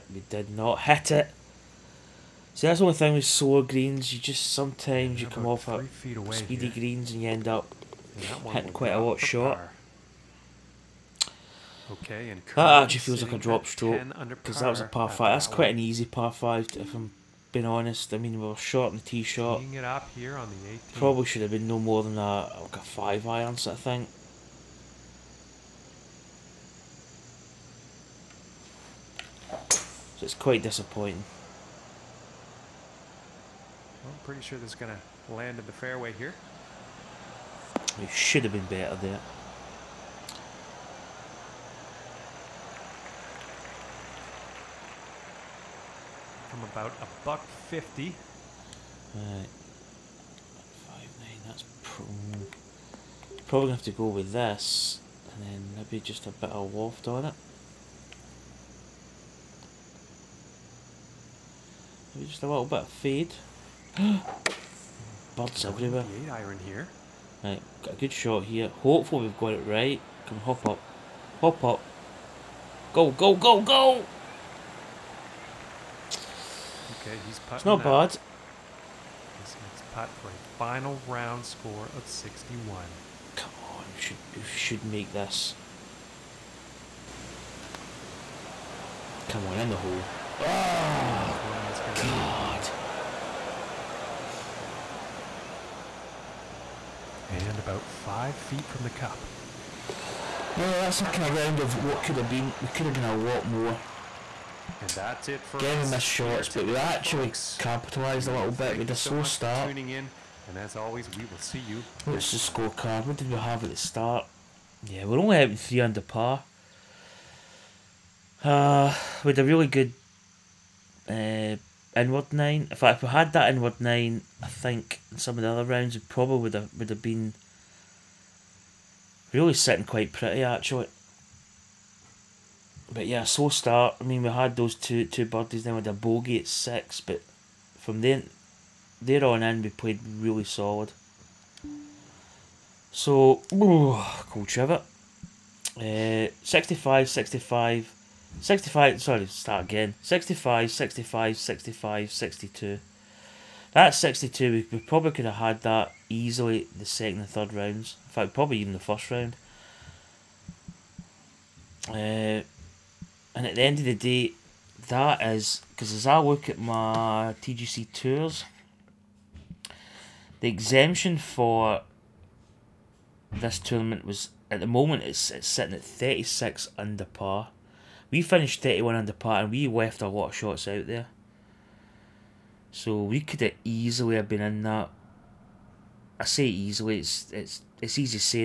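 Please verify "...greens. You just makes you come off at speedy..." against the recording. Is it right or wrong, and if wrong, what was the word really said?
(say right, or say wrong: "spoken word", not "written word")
wrong: "sometimes", not "makes".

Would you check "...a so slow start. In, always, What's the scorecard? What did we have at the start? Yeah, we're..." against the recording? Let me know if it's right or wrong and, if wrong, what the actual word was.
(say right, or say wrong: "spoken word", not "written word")
right.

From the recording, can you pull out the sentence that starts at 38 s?
It should have been better there.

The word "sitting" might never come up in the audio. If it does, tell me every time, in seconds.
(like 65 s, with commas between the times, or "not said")
129 s, 175 s.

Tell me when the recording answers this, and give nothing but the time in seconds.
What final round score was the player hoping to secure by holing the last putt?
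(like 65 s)
82 s.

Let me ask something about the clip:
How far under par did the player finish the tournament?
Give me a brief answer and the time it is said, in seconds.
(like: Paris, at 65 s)
31 under par, at 178 s.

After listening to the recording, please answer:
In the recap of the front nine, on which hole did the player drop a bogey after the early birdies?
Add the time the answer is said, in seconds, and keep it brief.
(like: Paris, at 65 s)
6, at 136 s.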